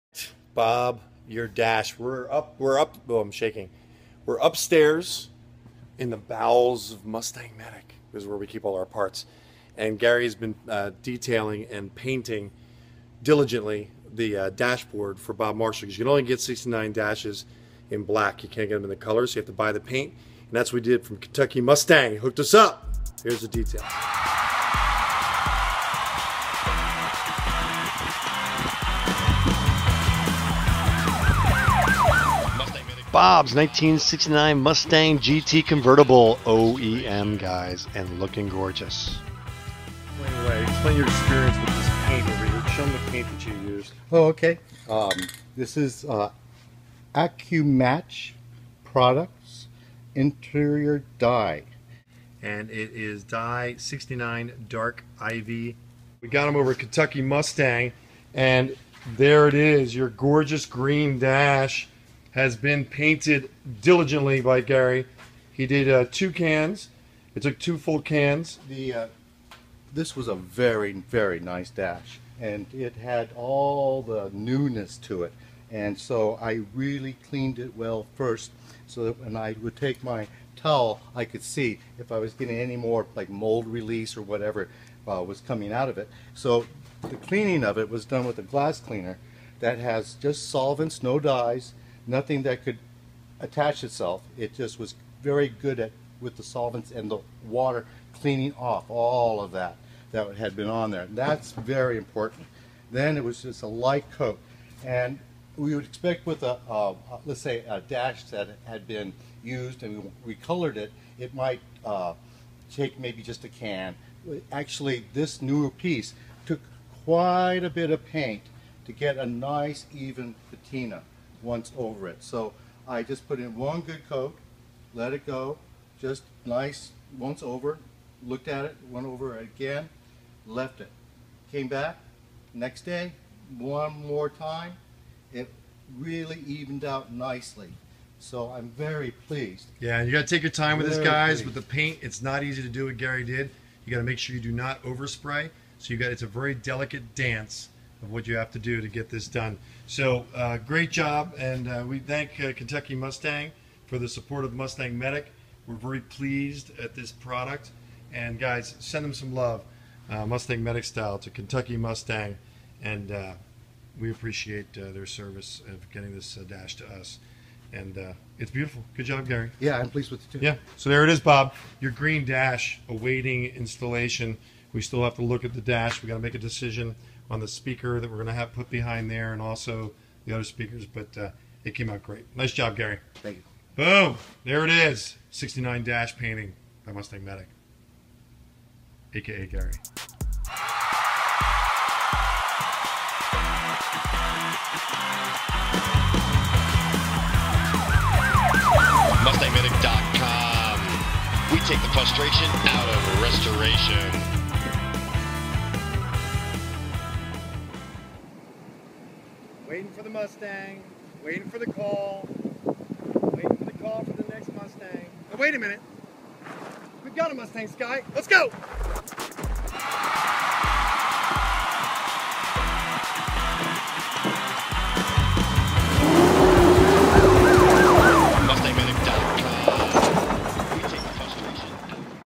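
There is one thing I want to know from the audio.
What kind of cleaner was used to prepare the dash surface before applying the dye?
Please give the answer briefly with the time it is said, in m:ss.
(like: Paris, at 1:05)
Glass cleaner, at 1:28.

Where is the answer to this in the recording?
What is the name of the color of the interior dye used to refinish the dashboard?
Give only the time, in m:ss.
0:54.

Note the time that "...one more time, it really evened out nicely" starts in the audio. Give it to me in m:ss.
2:13.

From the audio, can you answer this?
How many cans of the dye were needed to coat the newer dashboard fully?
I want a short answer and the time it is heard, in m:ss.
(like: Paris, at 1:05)
2, at 1:07.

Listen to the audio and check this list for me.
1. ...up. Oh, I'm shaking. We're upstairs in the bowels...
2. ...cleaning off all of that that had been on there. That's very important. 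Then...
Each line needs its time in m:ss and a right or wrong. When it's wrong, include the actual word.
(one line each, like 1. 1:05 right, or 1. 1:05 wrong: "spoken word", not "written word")
1. 0:02 right
2. 1:38 right.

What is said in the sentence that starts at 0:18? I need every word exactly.
You can't get them in the colors.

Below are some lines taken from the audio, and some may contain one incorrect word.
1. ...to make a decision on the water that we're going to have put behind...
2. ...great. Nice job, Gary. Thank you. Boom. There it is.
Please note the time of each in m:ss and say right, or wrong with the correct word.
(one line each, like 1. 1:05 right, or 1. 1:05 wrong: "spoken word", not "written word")
1. 2:56 wrong: "speaker", not "water"
2. 3:02 right.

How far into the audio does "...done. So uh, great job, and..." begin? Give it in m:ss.
2:29.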